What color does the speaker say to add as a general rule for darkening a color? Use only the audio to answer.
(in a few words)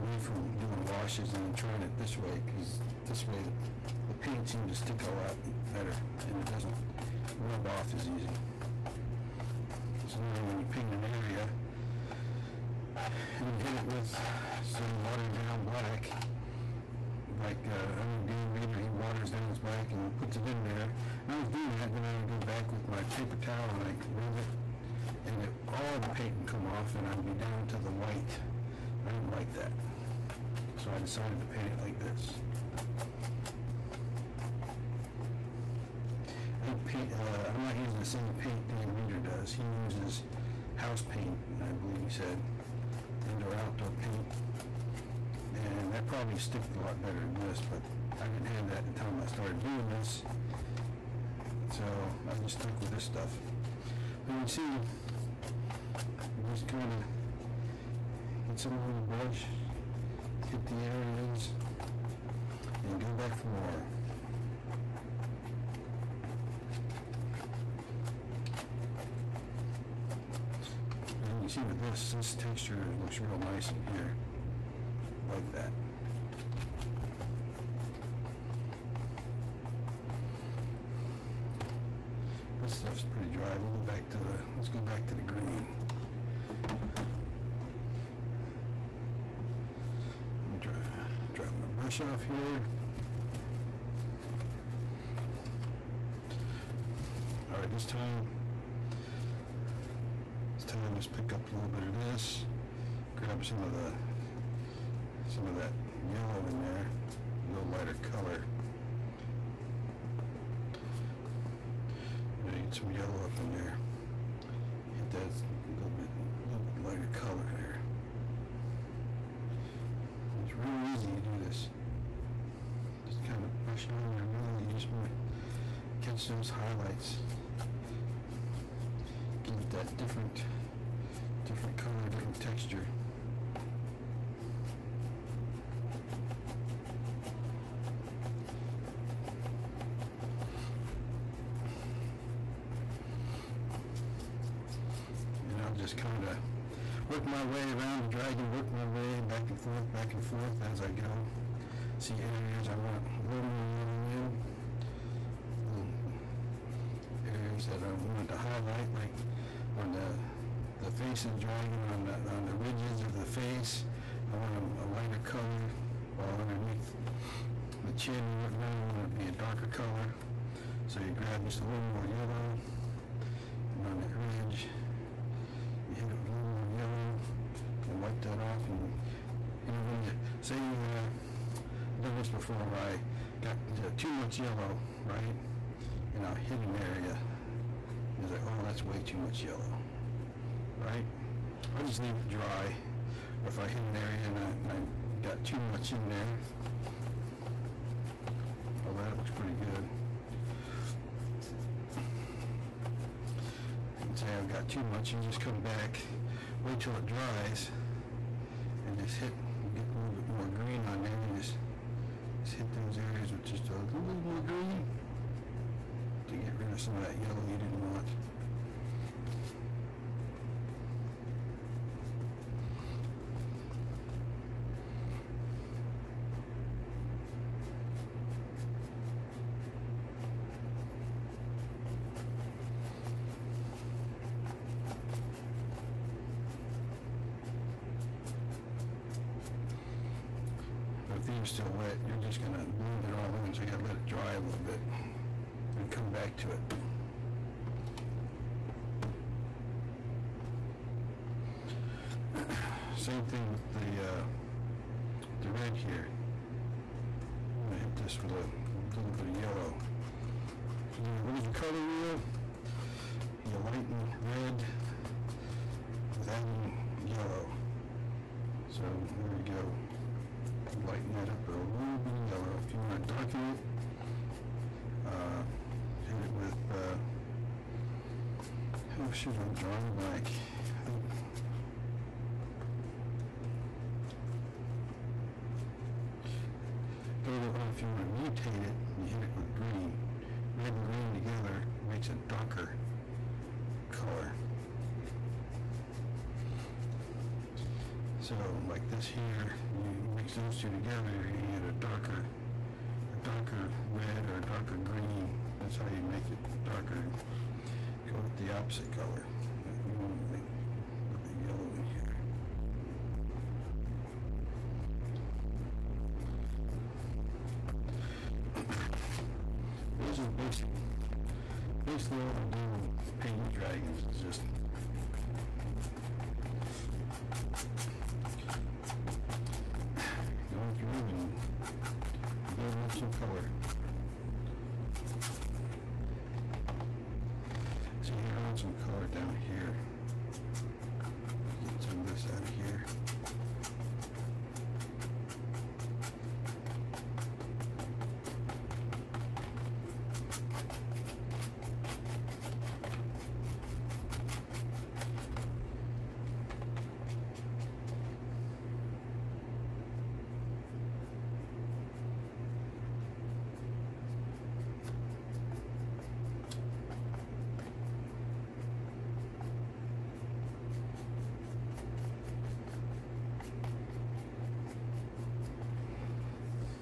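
The opposite color.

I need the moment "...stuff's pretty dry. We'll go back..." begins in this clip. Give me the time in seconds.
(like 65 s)
82 s.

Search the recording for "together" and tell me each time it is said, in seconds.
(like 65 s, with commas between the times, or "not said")
291 s, 300 s.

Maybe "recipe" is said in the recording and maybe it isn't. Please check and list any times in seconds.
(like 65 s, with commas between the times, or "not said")
not said.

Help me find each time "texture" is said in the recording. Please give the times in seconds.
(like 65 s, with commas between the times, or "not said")
72 s, 132 s.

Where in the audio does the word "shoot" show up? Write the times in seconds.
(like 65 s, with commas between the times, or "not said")
279 s.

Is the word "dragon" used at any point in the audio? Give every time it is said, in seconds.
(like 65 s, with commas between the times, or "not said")
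148 s, 161 s, 323 s.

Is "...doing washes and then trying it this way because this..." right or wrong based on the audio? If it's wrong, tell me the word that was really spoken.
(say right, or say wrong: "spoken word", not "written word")
right.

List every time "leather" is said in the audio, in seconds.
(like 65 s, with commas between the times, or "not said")
not said.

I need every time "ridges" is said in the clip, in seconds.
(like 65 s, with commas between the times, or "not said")
162 s, 174 s.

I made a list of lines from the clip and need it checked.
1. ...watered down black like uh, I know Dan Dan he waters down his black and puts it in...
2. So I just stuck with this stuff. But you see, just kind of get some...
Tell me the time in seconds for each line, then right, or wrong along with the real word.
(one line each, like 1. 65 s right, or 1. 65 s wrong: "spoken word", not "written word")
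1. 15 s wrong: "Reeder", not "Dan"
2. 51 s right.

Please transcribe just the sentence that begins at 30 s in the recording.
So I decided to paint it like this.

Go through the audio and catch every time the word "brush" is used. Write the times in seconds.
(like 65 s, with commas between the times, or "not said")
59 s, 91 s, 123 s.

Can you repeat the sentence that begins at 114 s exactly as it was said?
Hit that a little bit, a little bit lighter color there.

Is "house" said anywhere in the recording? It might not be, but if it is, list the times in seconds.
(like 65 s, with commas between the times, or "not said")
40 s.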